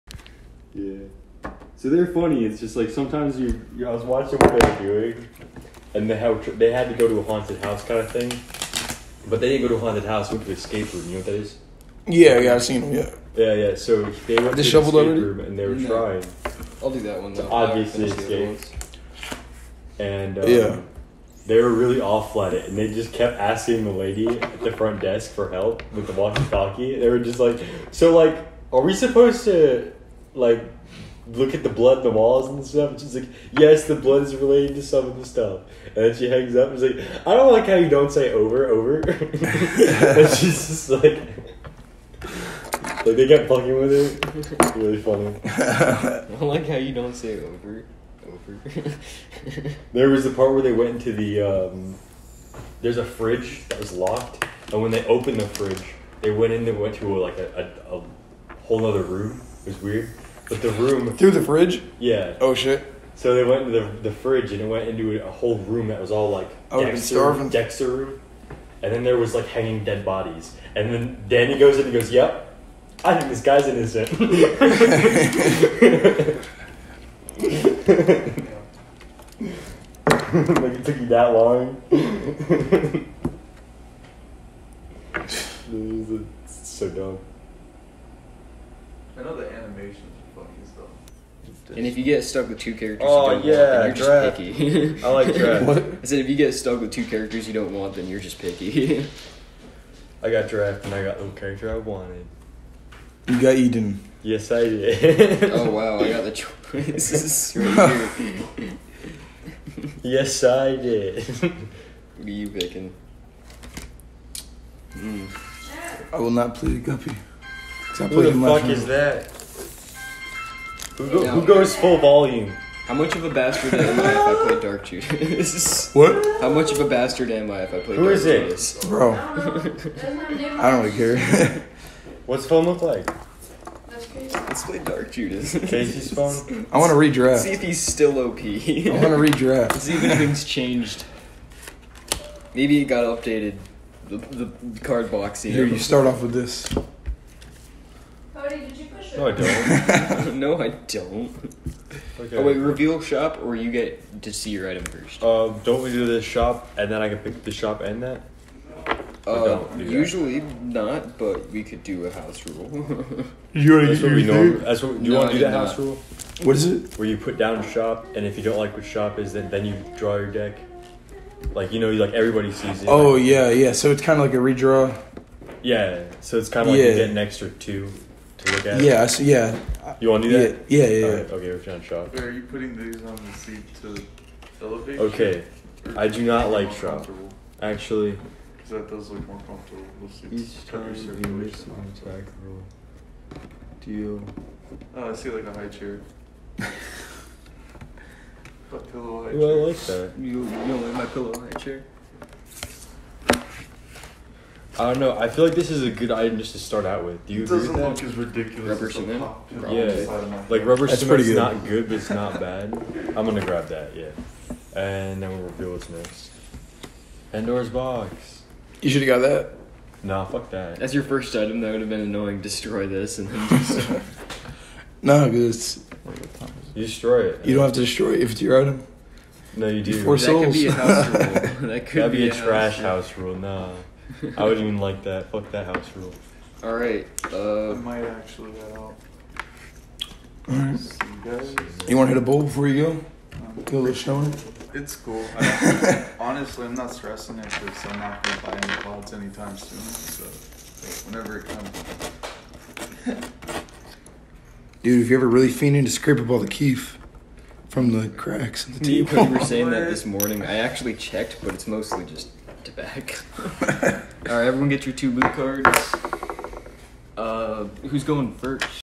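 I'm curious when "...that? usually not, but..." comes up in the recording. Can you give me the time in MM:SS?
02:39.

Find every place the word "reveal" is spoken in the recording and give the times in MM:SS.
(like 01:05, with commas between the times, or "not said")
02:32, 03:35.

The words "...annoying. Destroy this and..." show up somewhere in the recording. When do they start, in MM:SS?
03:42.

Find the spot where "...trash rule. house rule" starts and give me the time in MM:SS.
03:52.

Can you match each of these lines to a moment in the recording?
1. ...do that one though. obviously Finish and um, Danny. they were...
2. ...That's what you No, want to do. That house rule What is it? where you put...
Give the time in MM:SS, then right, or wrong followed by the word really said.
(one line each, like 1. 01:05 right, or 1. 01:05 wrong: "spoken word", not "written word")
1. 00:16 wrong: "Yeah", not "Danny"
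2. 02:44 right.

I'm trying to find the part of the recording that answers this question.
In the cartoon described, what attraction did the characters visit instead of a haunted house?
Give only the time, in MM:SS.
00:10.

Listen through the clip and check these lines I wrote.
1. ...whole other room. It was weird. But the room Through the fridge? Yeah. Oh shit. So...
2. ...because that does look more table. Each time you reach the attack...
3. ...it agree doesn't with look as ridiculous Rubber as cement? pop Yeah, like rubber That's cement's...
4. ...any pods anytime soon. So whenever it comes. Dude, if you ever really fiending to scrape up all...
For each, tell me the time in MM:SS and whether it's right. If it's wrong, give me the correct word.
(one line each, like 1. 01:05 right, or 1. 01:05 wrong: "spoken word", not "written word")
1. 00:58 right
2. 03:08 wrong: "comfortable", not "table"
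3. 03:27 right
4. 04:08 right.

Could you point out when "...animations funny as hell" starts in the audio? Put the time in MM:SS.
01:29.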